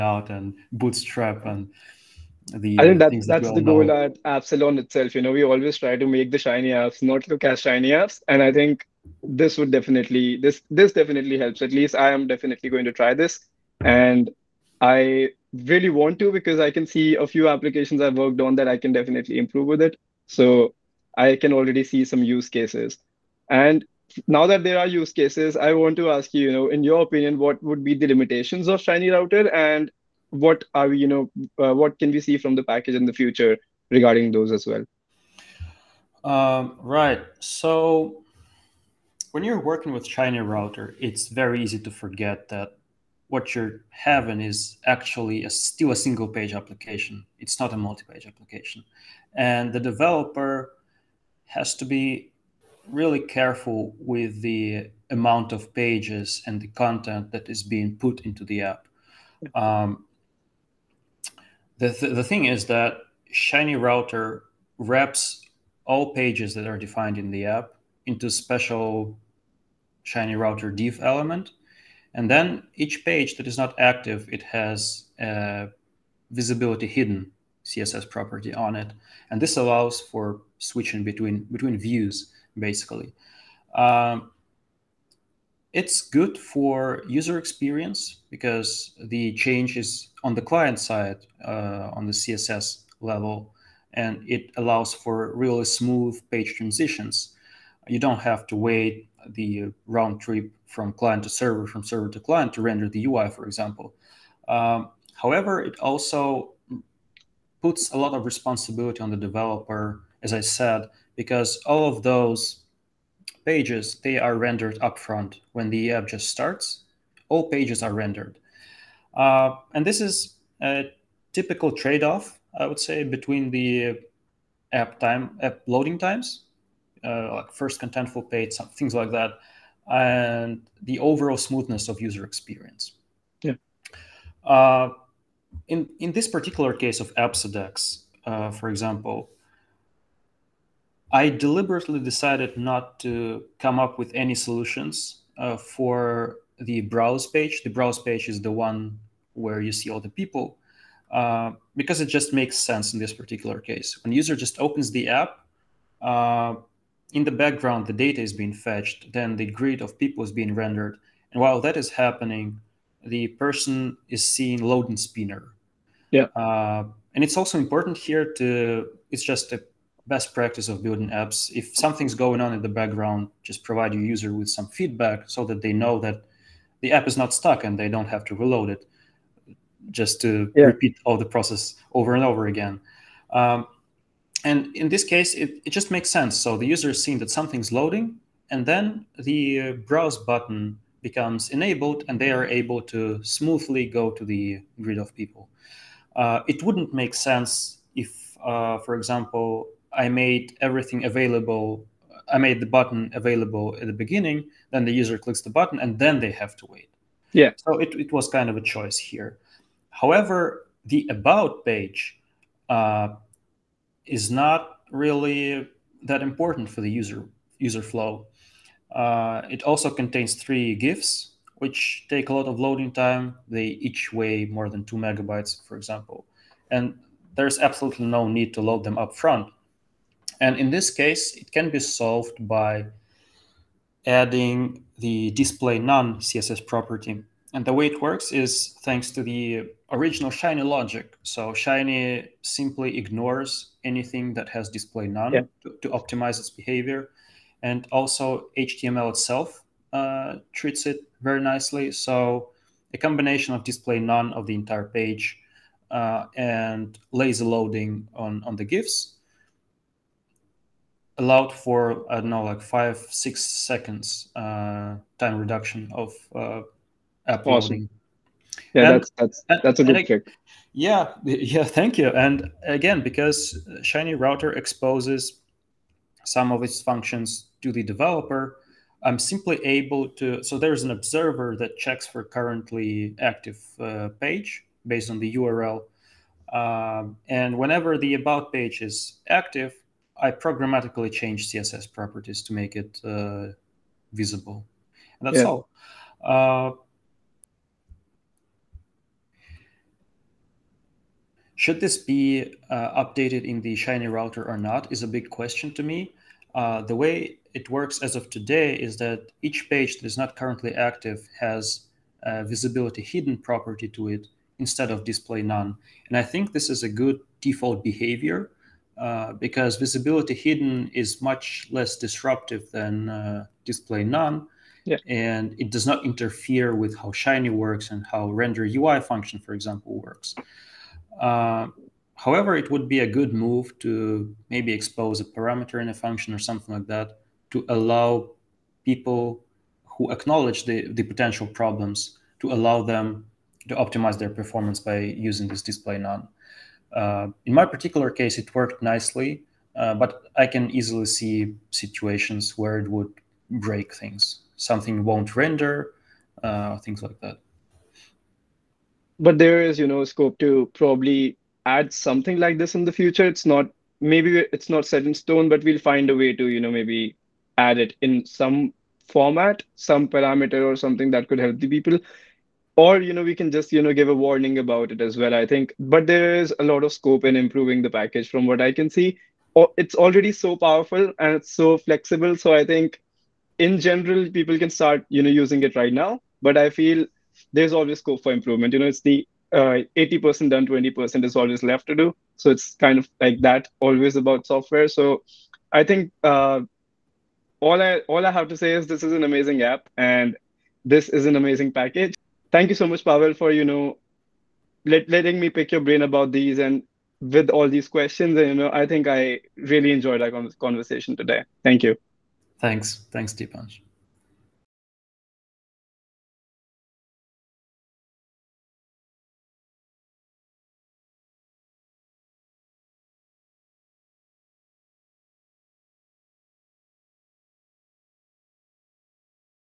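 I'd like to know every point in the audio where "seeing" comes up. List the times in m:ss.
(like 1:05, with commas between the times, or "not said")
2:44, 3:07.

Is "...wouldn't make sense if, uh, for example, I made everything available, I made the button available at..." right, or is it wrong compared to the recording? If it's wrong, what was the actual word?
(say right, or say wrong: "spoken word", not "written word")
right.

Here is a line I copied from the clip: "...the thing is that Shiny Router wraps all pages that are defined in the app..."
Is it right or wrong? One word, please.
right.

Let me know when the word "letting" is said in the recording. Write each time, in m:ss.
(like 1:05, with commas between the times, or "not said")
6:45.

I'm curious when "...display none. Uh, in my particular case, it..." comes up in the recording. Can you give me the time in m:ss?
5:45.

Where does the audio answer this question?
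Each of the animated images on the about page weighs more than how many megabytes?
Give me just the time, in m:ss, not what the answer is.
3:44.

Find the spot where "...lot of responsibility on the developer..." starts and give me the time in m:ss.
1:47.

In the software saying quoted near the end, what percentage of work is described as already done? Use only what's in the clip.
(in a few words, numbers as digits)
80%.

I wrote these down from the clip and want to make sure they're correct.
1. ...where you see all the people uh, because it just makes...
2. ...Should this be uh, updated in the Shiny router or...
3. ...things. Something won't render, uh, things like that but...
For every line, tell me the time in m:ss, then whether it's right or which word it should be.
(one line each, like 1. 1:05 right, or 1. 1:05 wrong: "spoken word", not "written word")
1. 2:29 right
2. 5:01 right
3. 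5:53 right.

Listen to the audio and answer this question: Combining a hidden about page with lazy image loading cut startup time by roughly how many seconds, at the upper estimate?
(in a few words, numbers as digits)
6.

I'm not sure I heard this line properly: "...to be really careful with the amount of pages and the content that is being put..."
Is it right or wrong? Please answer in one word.
right.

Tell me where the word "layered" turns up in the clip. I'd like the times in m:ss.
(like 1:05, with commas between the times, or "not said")
not said.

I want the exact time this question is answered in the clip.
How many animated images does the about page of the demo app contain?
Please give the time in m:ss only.
3:40.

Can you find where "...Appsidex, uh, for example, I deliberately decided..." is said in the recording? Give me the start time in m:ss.
2:17.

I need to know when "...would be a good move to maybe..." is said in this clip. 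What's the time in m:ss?
5:32.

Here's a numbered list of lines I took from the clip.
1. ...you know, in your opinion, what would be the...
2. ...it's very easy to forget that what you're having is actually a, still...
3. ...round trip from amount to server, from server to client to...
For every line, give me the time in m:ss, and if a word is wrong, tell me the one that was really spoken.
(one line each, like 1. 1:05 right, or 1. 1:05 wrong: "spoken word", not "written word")
1. 0:26 right
2. 0:41 right
3. 1:39 wrong: "client", not "amount".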